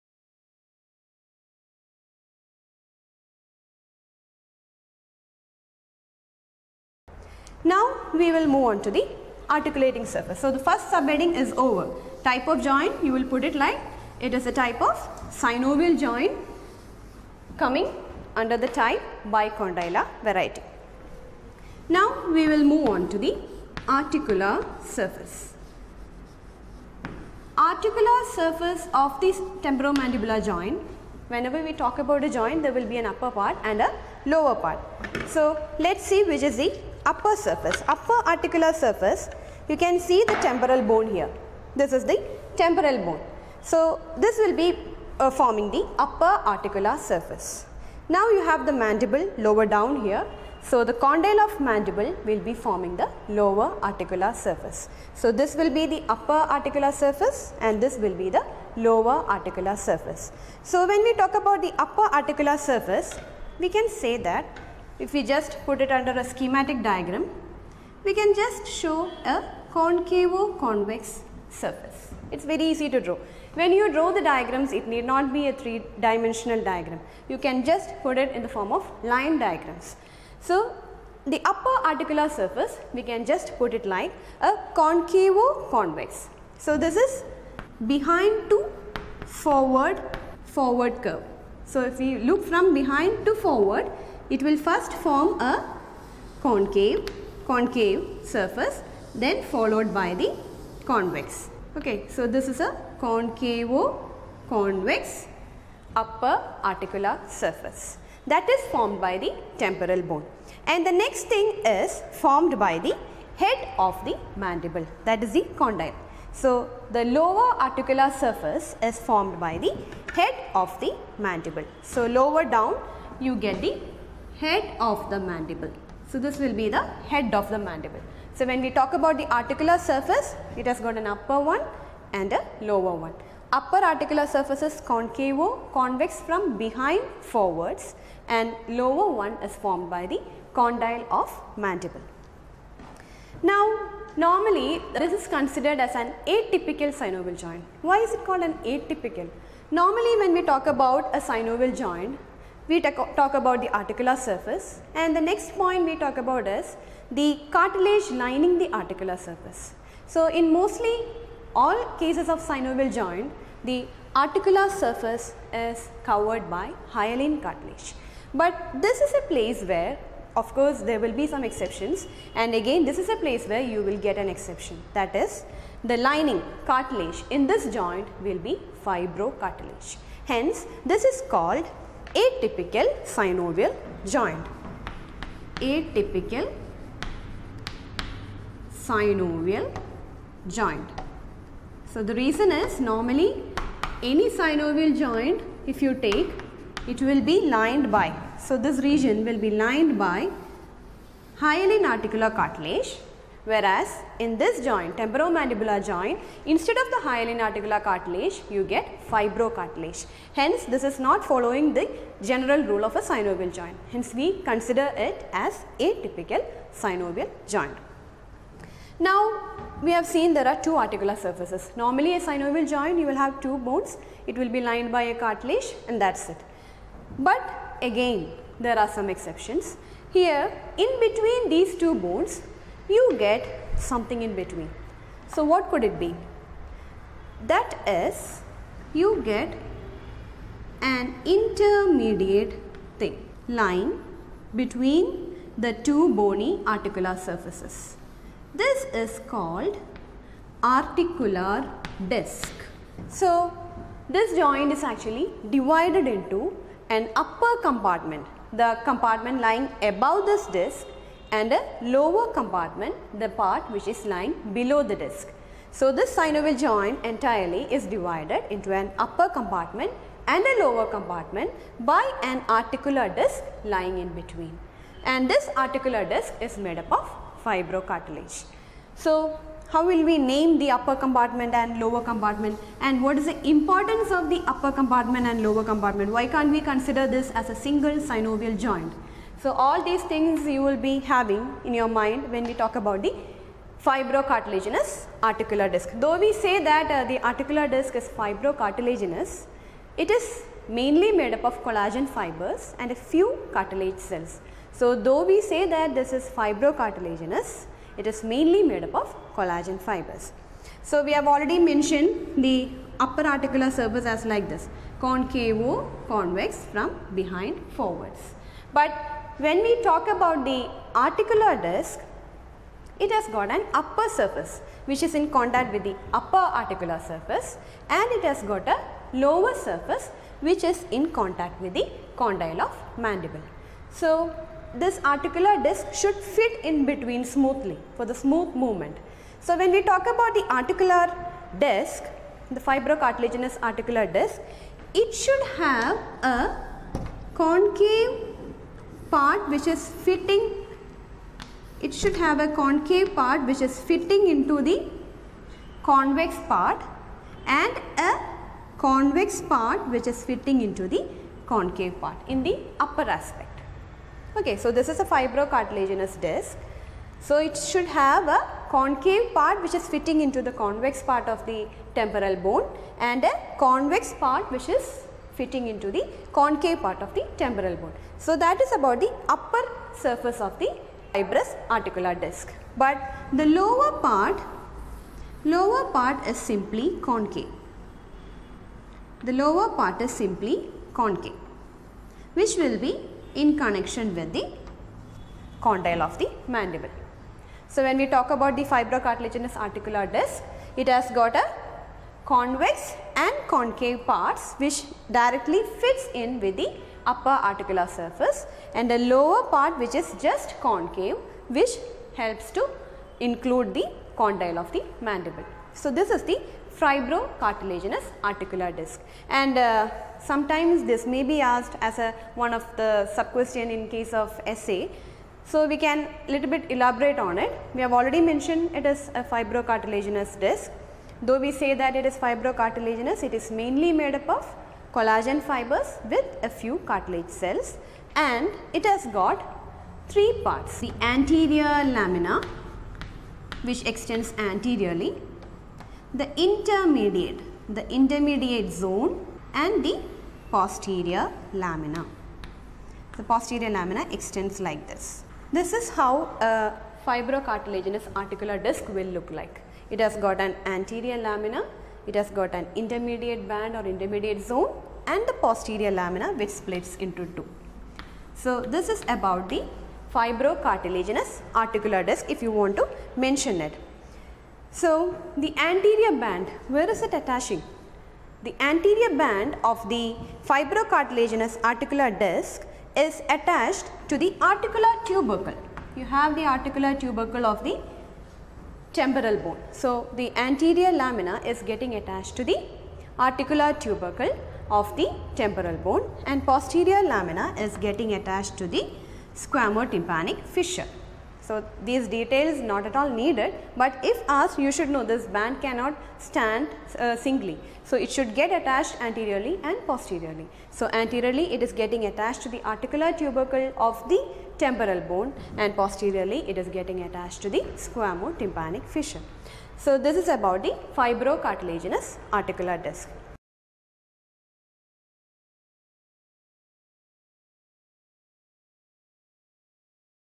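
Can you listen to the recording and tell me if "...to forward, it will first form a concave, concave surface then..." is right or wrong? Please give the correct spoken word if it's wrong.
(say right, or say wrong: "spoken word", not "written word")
right.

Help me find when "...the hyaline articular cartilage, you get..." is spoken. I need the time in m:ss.
3:26.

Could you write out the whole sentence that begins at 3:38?
Now, we have seen there are two articular surfaces.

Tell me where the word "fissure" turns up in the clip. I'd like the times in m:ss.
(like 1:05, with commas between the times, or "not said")
8:20, 8:38.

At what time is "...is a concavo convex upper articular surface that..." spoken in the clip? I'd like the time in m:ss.
1:42.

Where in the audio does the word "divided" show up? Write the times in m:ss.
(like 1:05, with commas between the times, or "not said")
4:15, 4:27.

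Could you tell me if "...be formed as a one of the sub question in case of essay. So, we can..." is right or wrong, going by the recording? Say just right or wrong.
wrong.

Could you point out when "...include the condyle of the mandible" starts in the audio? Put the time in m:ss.
6:53.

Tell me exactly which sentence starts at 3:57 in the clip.
That is, you get an intermediate thing, line between the two bony articular surfaces.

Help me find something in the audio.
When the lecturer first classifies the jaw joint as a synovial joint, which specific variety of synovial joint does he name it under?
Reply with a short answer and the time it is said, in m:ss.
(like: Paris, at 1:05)
Bicondylar, at 0:19.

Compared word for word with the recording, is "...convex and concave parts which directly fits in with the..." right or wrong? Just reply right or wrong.
right.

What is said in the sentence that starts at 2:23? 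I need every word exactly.
Now, normally this is considered as an atypical synovial joint.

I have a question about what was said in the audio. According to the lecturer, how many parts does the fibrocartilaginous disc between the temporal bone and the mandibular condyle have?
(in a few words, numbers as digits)
3.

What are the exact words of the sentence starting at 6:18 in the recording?
So that is about the upper surface of the fibrous articular disc.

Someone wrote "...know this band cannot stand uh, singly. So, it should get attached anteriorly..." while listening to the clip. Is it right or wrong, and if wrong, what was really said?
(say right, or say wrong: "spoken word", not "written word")
right.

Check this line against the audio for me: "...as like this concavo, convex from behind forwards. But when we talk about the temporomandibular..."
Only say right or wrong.
wrong.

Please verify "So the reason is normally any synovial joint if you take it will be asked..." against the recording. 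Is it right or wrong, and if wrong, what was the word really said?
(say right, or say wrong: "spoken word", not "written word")
wrong: "lined", not "asked".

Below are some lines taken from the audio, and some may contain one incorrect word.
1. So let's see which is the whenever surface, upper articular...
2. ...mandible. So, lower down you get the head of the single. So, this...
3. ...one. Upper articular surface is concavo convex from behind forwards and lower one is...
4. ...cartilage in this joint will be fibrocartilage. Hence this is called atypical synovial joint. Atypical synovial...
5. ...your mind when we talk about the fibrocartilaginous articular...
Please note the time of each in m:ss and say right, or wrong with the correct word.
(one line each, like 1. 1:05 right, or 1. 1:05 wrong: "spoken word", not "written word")
1. 0:35 wrong: "upper", not "whenever"
2. 2:01 wrong: "mandible", not "single"
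3. 2:13 right
4. 2:56 right
5. 4:51 right.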